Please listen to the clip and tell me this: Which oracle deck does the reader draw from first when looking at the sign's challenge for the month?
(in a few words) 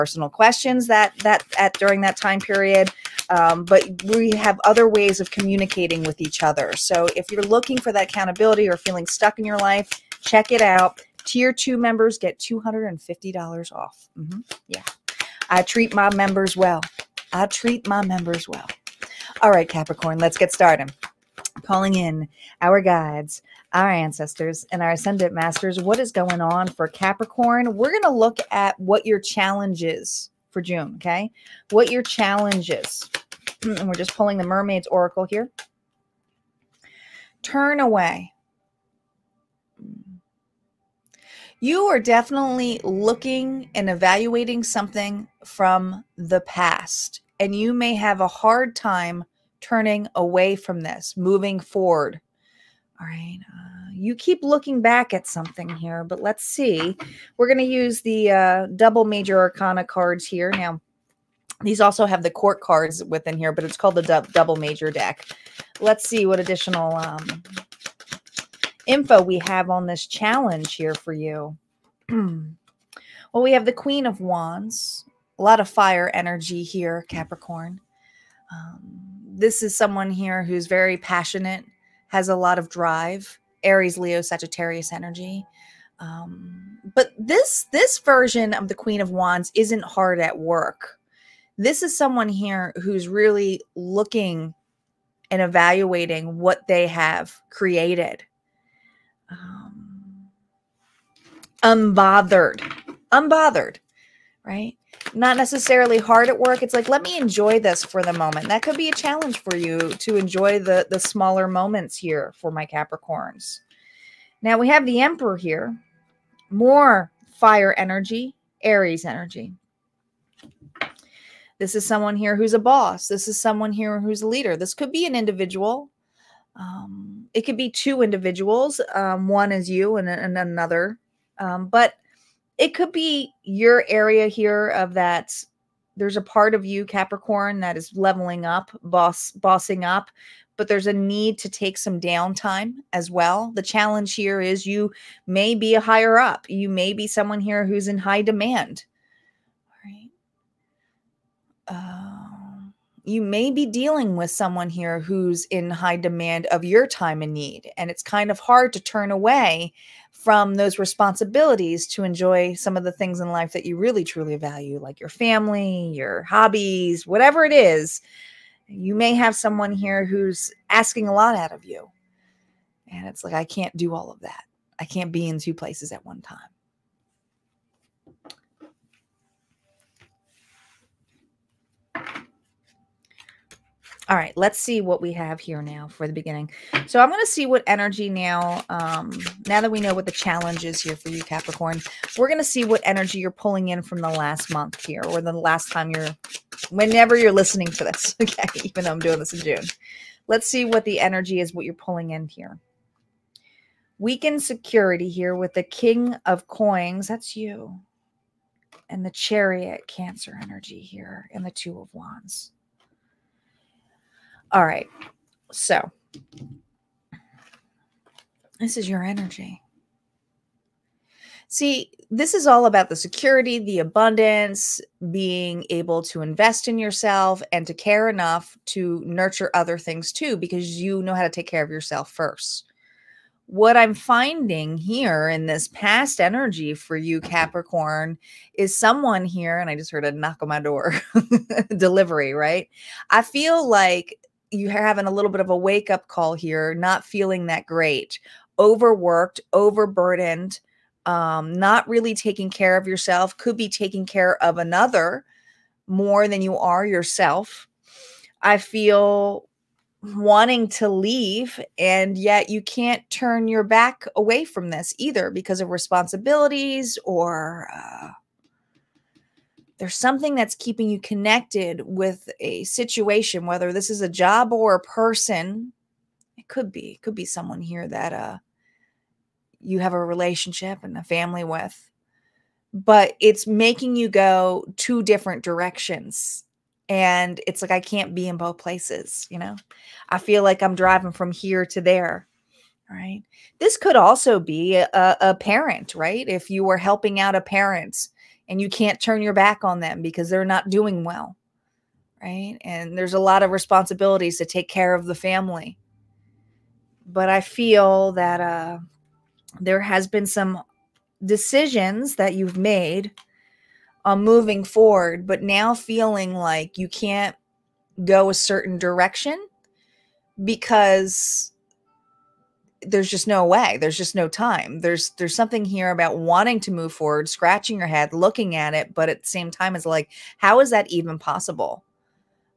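Mermaid's Oracle.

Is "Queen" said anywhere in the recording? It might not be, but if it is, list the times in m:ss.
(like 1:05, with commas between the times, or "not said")
1:13, 1:28.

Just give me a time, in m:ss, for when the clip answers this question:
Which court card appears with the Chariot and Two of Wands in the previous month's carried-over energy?
3:25.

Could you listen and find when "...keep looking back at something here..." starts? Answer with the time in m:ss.
0:54.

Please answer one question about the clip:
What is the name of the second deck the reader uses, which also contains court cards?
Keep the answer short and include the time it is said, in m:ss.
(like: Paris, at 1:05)
double major deck, at 1:04.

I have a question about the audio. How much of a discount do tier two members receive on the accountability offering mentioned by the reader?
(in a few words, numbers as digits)
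$250.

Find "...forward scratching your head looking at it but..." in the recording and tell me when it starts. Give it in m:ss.
5:26.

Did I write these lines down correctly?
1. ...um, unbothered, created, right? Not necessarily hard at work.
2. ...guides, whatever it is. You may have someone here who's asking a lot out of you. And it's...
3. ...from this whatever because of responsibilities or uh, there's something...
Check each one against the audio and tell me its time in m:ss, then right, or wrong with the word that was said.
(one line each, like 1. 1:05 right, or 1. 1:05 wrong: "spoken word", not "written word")
1. 1:39 wrong: "unbothered", not "created"
2. 2:46 wrong: "hobbies", not "guides"
3. 4:24 wrong: "either", not "whatever".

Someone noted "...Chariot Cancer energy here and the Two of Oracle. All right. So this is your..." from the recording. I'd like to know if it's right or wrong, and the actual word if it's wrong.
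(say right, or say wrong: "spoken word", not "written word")
wrong: "Wands", not "Oracle".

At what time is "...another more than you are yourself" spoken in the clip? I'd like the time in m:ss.
4:14.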